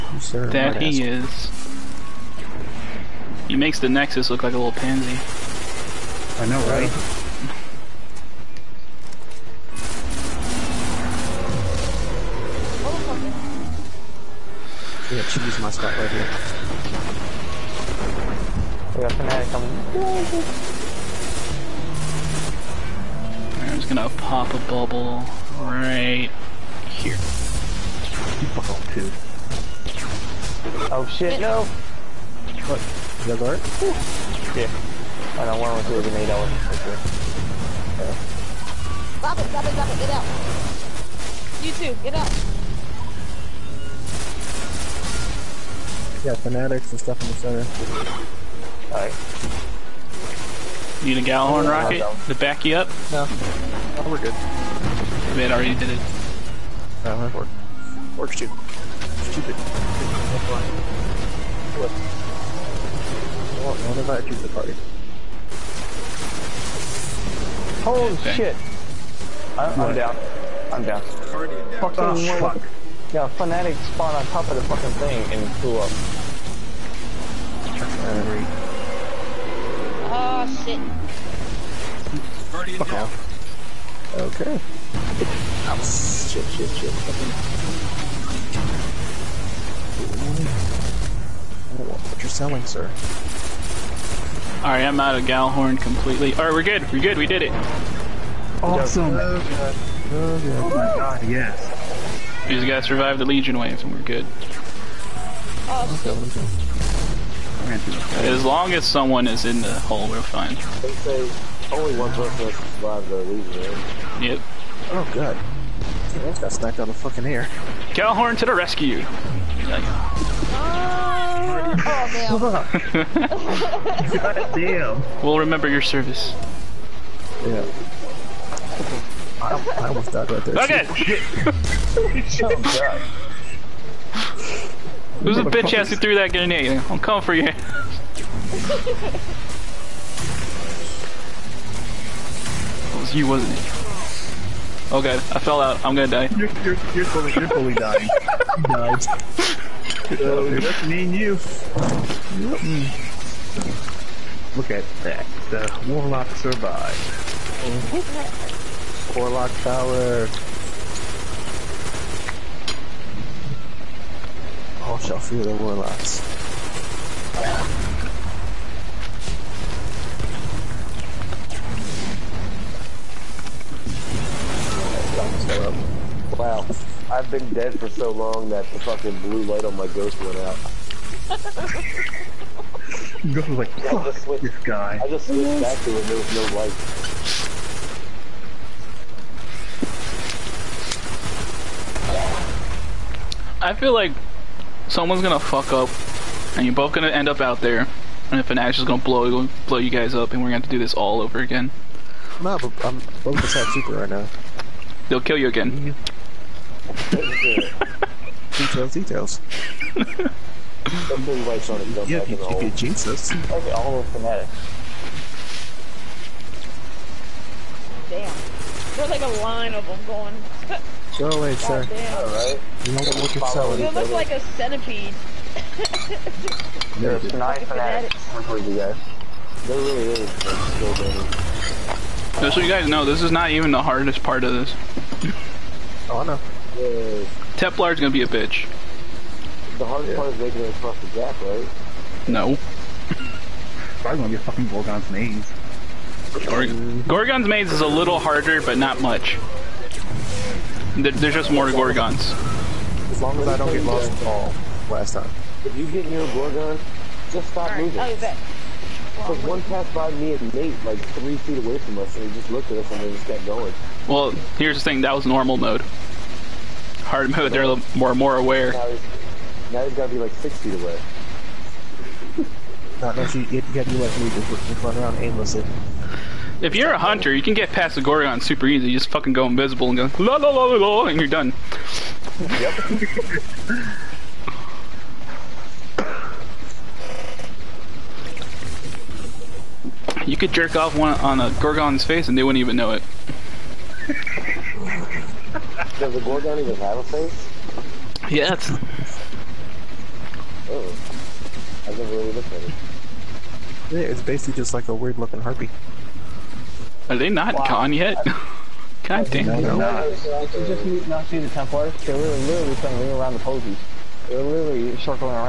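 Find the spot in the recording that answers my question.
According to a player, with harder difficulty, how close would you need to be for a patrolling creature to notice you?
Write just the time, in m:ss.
4:30.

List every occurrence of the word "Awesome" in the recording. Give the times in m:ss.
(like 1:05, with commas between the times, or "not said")
1:38, 1:45.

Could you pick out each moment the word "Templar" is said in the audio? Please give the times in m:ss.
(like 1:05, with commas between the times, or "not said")
3:57, 5:11.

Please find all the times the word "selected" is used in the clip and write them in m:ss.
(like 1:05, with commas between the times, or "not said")
not said.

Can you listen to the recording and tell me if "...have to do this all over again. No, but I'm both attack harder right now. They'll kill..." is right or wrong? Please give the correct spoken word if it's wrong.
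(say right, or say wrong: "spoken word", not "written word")
wrong: "super", not "harder".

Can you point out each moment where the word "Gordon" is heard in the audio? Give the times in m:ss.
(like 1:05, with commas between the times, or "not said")
not said.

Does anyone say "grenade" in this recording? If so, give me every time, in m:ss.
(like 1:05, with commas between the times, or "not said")
0:36, 2:16.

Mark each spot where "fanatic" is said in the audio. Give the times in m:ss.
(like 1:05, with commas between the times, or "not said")
0:19, 0:46, 1:13, 3:34, 3:47.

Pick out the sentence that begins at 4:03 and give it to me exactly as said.
Probably gonna get fucking Gorgon's maze.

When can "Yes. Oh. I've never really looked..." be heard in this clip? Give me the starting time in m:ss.
4:58.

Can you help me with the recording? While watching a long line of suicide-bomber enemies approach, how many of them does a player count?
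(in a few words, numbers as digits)
9.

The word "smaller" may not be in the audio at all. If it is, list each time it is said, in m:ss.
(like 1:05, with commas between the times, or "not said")
not said.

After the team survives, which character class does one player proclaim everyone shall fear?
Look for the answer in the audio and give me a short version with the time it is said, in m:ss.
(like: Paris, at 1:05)
Warlocks, at 2:44.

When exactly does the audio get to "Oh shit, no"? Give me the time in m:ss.
0:30.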